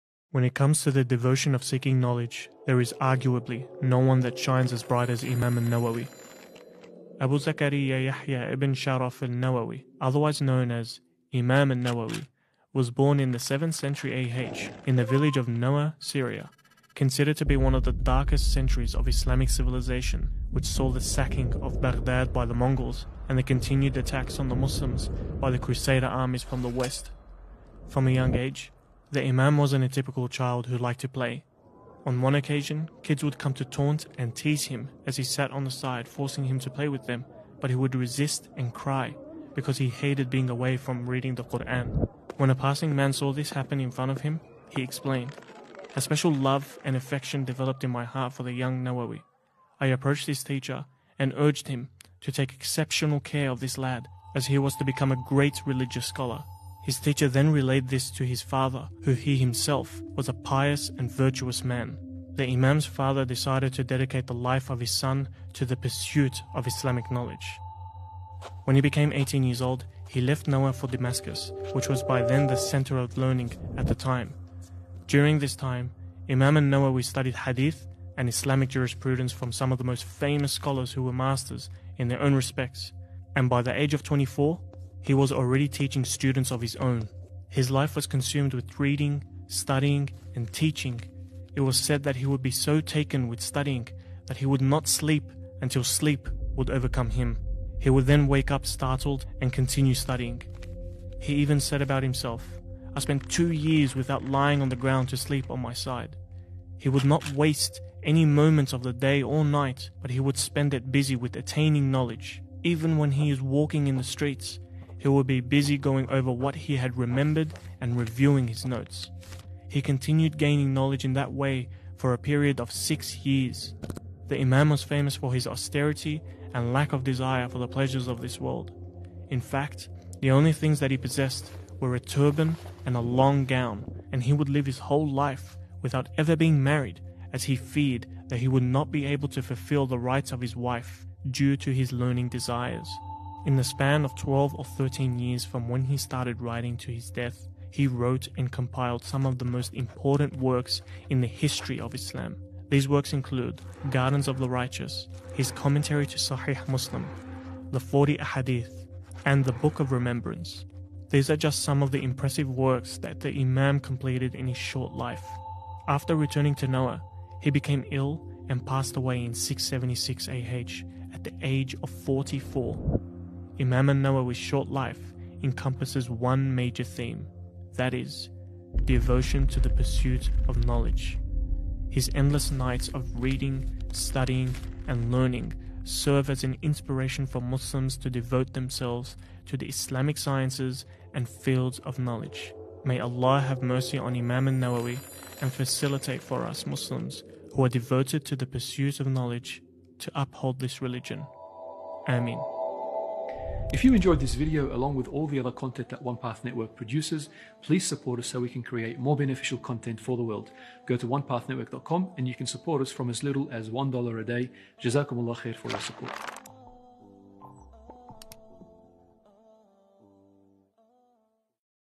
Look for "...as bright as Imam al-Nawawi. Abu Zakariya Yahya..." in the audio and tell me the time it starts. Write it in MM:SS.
00:04.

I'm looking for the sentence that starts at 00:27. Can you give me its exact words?
From a young age, the Imam wasn't a typical child who liked to play.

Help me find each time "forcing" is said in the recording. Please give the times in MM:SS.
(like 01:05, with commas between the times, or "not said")
00:36.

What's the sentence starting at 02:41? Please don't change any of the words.
These are just some of the impressive works that the Imam completed in his short life.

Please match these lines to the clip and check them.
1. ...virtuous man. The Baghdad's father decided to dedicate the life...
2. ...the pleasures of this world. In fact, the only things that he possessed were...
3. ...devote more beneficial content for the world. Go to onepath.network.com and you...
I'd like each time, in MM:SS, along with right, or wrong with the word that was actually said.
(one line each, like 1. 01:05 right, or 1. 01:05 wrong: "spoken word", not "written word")
1. 01:01 wrong: "Imam", not "Baghdad"
2. 02:07 right
3. 03:28 wrong: "create", not "devote".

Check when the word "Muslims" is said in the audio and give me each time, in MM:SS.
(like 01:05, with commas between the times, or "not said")
00:24, 02:36, 03:07, 03:16.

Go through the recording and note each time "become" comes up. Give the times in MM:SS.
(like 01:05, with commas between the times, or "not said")
00:54.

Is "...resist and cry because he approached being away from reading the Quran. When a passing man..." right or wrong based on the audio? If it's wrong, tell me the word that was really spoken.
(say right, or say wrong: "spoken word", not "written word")
wrong: "hated", not "approached".